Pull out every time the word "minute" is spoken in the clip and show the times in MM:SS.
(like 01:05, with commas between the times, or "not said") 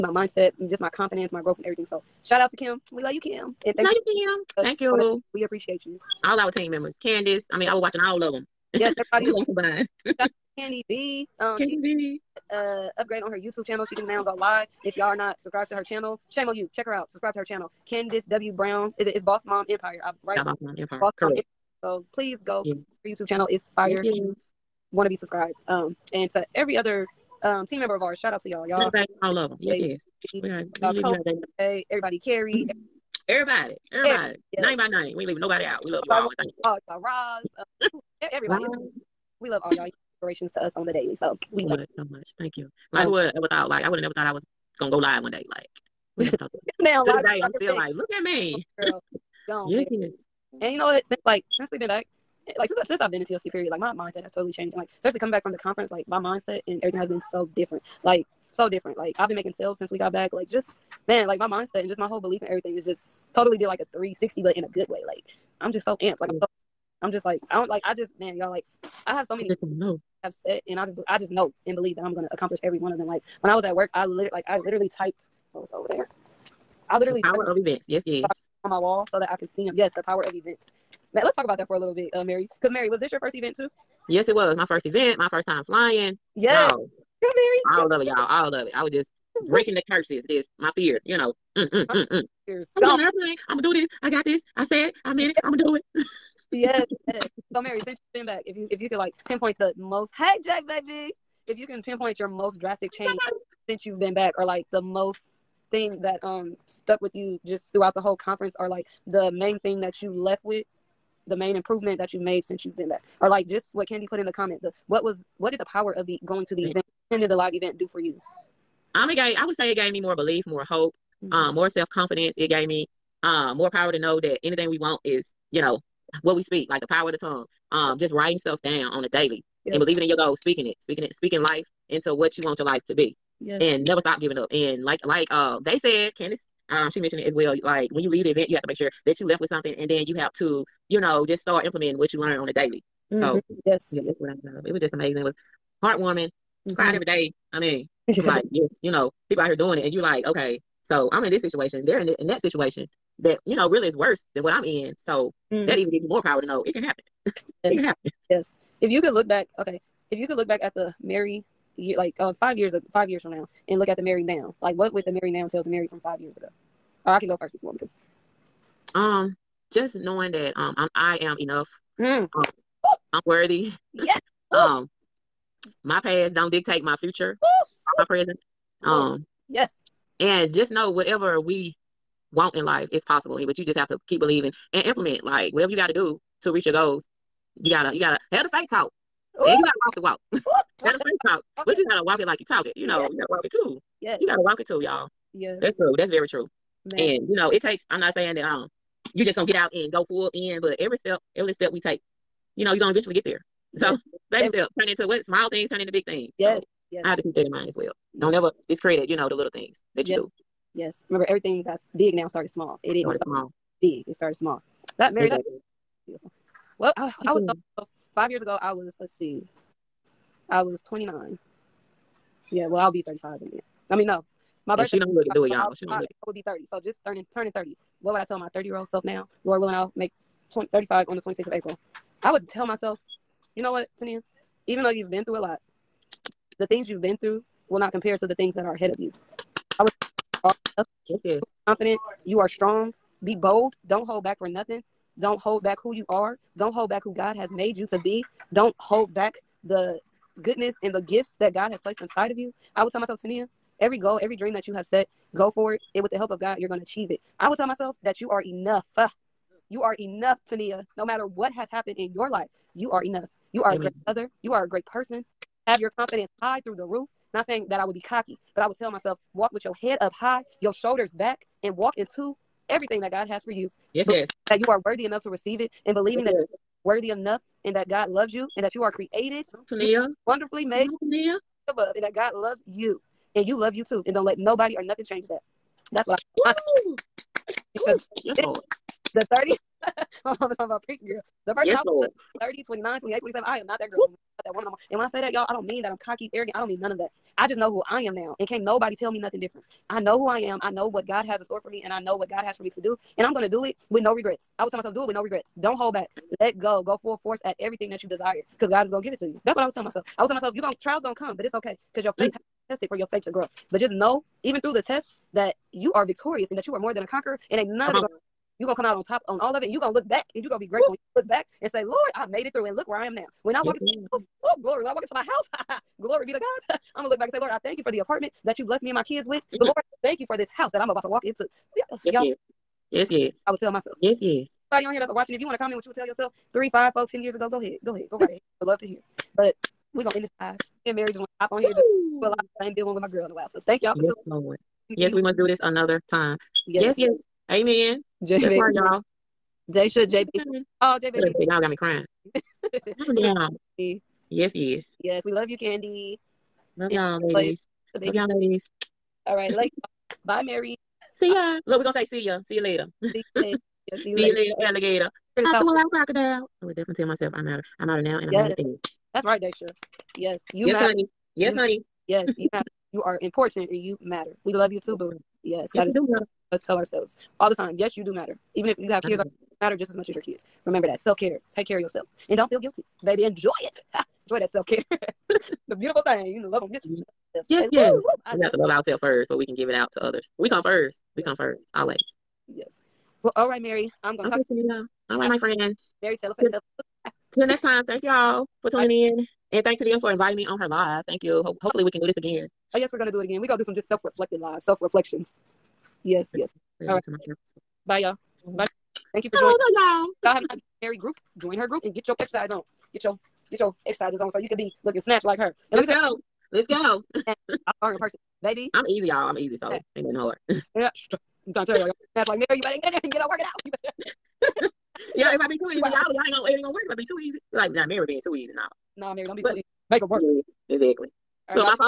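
03:43.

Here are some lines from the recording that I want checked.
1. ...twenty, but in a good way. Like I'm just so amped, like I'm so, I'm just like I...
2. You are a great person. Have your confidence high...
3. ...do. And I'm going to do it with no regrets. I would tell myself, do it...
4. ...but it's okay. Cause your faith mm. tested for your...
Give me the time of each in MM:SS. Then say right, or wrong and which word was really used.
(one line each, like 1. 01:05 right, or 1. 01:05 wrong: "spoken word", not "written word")
1. 01:04 wrong: "sixty", not "twenty"
2. 04:24 right
3. 05:02 right
4. 05:11 right.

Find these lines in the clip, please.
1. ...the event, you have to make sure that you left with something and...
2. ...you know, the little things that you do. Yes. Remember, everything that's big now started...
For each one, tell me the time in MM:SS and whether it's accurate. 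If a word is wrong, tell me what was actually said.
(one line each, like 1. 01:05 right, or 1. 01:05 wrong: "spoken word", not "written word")
1. 02:18 right
2. 03:29 right.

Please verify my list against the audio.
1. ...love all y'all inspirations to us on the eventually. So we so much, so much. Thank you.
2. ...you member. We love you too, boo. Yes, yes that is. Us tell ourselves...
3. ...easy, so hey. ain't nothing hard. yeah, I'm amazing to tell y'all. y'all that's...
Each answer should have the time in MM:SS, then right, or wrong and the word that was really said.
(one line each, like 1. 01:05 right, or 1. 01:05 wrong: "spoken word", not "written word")
1. 00:39 wrong: "daily", not "eventually"
2. 06:13 wrong: "matter", not "member"
3. 06:59 wrong: "trying", not "amazing".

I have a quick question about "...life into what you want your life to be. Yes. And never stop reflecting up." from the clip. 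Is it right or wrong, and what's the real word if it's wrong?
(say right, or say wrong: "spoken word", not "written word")
wrong: "giving", not "reflecting".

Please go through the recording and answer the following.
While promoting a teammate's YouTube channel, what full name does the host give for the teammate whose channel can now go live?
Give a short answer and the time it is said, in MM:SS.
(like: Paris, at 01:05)
Candace W. Brown, at 00:17.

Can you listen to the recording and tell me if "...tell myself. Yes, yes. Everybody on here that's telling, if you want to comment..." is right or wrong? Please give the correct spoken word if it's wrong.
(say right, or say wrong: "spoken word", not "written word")
wrong: "watching", not "telling".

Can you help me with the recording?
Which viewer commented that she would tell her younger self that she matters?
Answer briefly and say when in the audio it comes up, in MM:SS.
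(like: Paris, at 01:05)
Daisha, at 06:09.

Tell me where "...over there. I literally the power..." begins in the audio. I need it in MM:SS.
01:15.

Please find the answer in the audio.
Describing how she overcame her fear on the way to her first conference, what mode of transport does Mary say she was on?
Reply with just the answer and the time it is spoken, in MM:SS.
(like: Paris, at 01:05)
An airplane, at 01:33.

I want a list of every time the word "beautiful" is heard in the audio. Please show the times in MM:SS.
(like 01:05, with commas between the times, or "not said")
03:36, 06:25.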